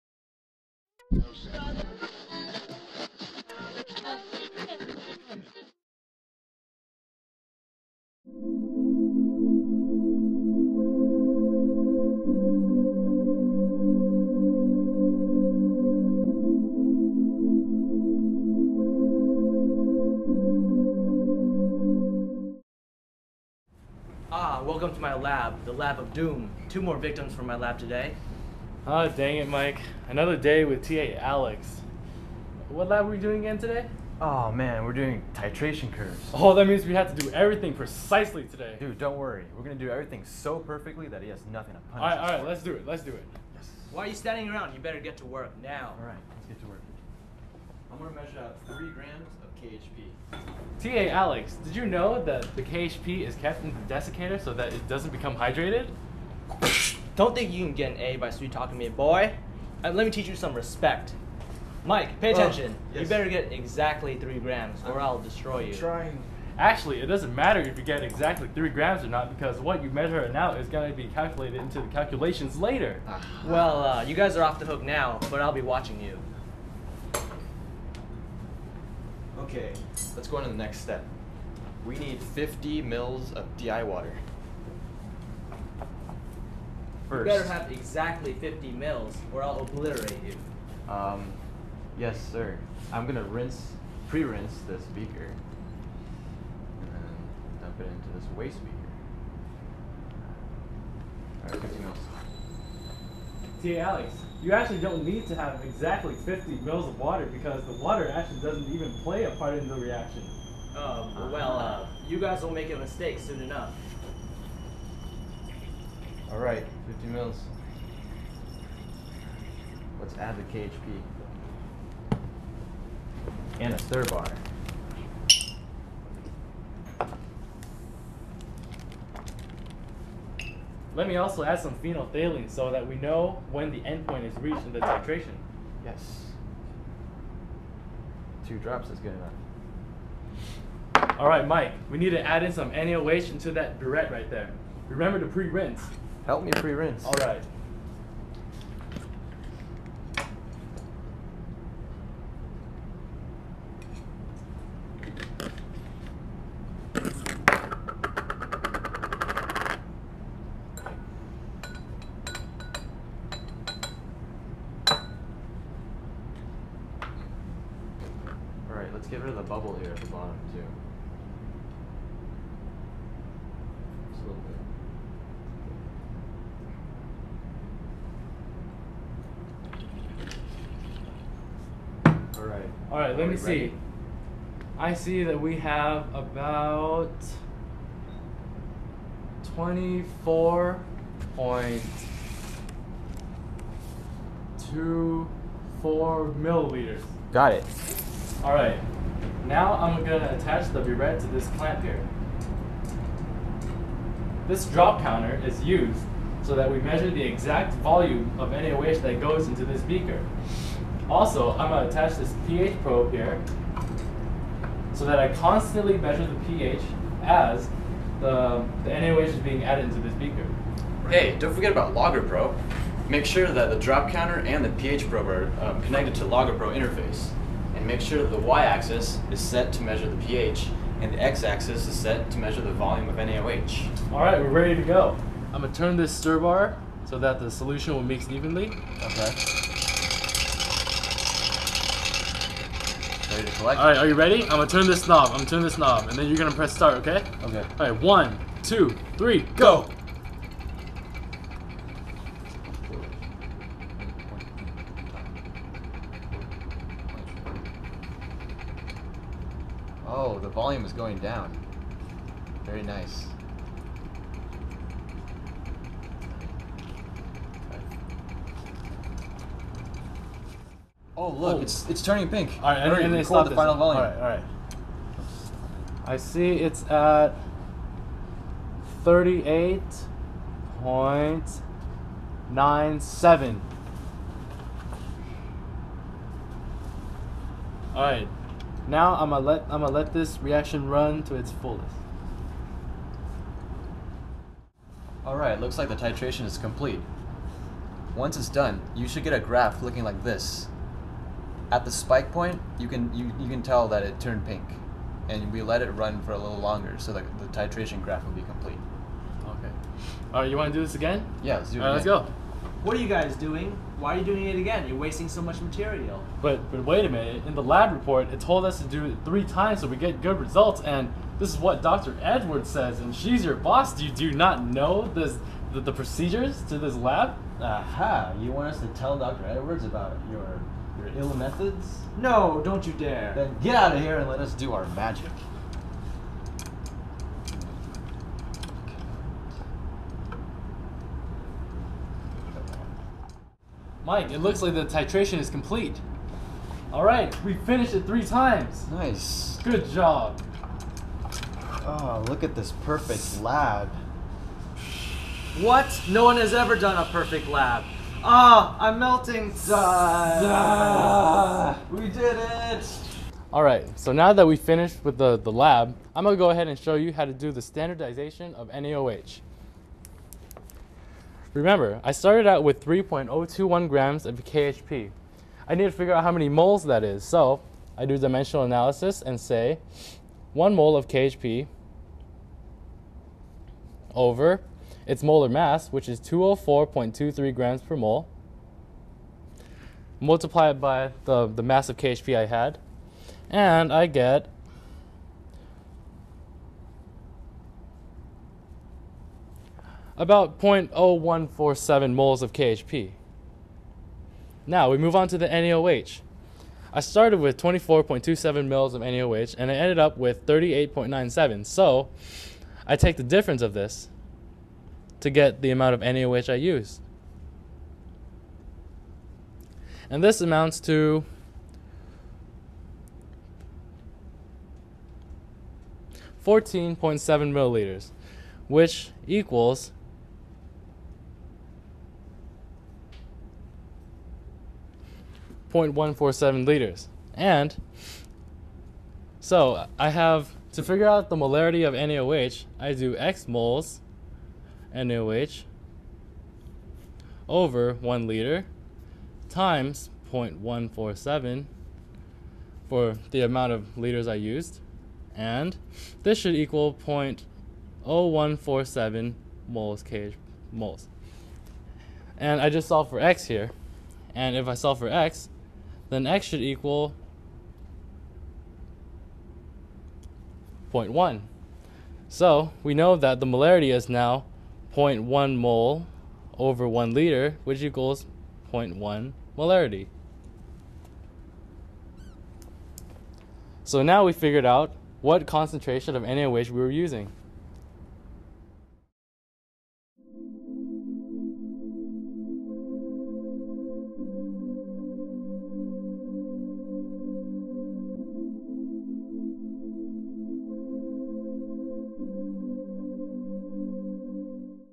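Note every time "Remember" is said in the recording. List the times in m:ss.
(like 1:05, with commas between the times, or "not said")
2:24, 6:11.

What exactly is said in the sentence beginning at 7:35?
And this should equal 0.0147 moles kh moles.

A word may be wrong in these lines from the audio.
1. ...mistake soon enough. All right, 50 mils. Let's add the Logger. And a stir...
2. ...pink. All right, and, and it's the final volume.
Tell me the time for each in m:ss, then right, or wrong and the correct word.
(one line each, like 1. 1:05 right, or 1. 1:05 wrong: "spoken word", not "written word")
1. 1:52 wrong: "KHP", not "Logger"
2. 4:32 right.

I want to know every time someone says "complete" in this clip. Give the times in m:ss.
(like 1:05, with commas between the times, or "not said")
4:56, 5:08, 5:45.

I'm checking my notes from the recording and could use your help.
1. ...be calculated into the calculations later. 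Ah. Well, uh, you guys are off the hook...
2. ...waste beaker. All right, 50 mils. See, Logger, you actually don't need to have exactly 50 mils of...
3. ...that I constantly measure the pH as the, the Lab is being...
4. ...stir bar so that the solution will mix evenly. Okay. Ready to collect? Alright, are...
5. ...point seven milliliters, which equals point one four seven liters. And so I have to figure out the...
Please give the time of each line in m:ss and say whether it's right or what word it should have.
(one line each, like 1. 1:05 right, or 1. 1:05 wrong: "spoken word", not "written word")
1. 1:10 right
2. 1:38 wrong: "Alex", not "Logger"
3. 3:35 wrong: "NaOH", not "Lab"
4. 3:56 right
5. 7:06 right.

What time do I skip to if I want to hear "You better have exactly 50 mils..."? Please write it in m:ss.
1:27.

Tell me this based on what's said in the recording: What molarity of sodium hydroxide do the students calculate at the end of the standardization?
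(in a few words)
0.1 M.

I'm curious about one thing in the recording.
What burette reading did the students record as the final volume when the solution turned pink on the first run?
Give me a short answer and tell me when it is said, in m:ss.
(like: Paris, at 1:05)
38.97, at 4:39.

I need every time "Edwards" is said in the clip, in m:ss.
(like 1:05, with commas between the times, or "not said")
5:22, 5:29.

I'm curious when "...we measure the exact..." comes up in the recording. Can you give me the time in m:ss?
3:26.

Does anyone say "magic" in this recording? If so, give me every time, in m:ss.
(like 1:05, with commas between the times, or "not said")
5:34.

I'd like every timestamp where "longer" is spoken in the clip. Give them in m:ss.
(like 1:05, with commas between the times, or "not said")
5:06.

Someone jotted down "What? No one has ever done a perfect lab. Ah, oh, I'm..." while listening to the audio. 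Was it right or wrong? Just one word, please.
right.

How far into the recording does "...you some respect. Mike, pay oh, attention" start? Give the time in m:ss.
1:00.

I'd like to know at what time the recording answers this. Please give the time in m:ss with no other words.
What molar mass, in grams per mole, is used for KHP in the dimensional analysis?
6:26.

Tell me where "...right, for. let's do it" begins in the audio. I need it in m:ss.
0:42.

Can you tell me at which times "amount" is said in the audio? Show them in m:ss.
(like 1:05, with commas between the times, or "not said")
6:55, 7:00, 7:33.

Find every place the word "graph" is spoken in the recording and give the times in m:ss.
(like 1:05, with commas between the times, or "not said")
4:59, 5:08.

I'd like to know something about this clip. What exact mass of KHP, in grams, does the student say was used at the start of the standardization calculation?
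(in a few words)
3.021 grams.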